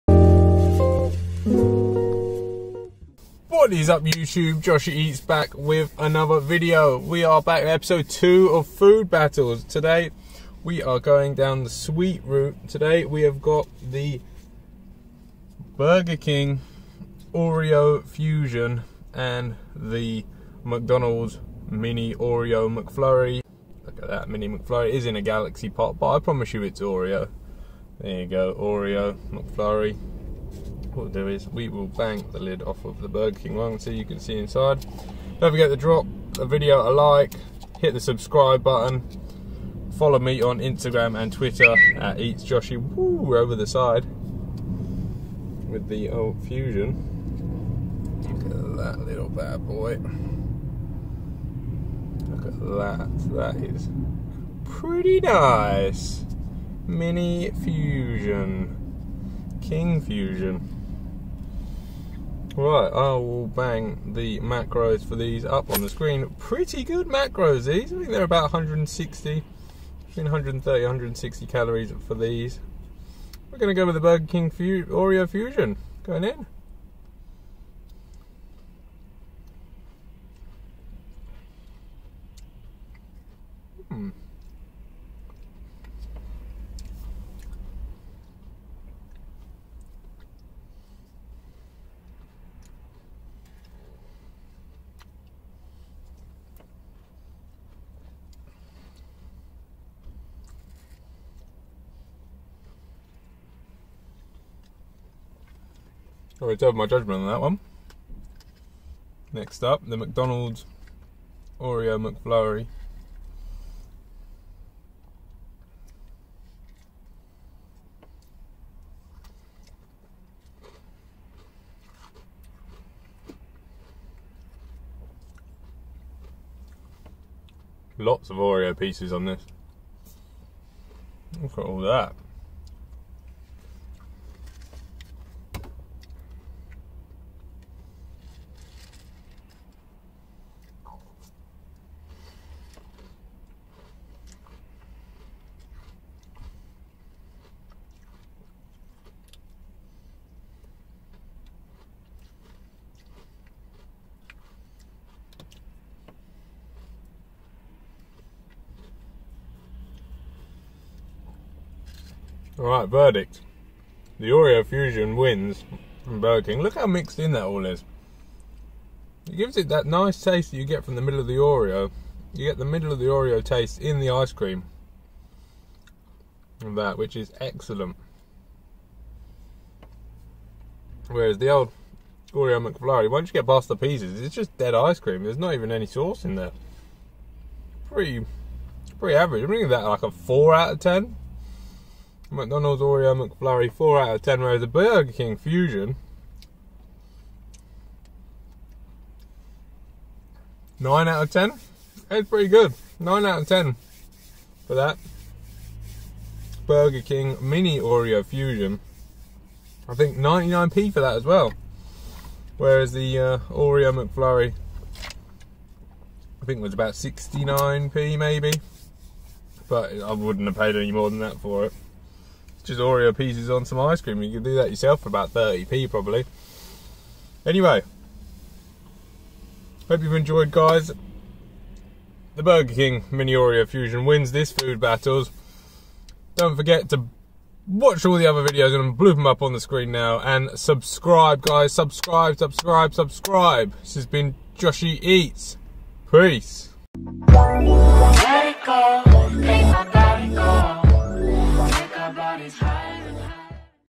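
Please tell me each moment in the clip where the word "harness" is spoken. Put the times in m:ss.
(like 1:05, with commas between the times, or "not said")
not said.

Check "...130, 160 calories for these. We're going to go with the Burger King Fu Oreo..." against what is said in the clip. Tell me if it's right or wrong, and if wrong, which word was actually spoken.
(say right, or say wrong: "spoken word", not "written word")
right.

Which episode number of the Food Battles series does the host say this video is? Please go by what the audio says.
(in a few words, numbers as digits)
2.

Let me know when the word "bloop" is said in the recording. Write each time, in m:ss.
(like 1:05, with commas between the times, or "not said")
3:58.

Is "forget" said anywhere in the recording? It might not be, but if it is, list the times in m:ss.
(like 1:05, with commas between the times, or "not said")
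0:35, 3:56.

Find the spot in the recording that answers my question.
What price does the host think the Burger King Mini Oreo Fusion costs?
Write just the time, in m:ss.
3:30.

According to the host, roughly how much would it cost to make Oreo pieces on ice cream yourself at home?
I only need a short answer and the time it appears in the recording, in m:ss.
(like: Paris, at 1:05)
30p, at 3:45.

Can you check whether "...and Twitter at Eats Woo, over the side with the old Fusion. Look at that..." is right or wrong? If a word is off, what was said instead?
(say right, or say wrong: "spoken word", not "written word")
right.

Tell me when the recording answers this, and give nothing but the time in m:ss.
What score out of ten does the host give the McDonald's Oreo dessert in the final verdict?
3:13.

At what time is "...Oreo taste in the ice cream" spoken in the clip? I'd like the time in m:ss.
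2:53.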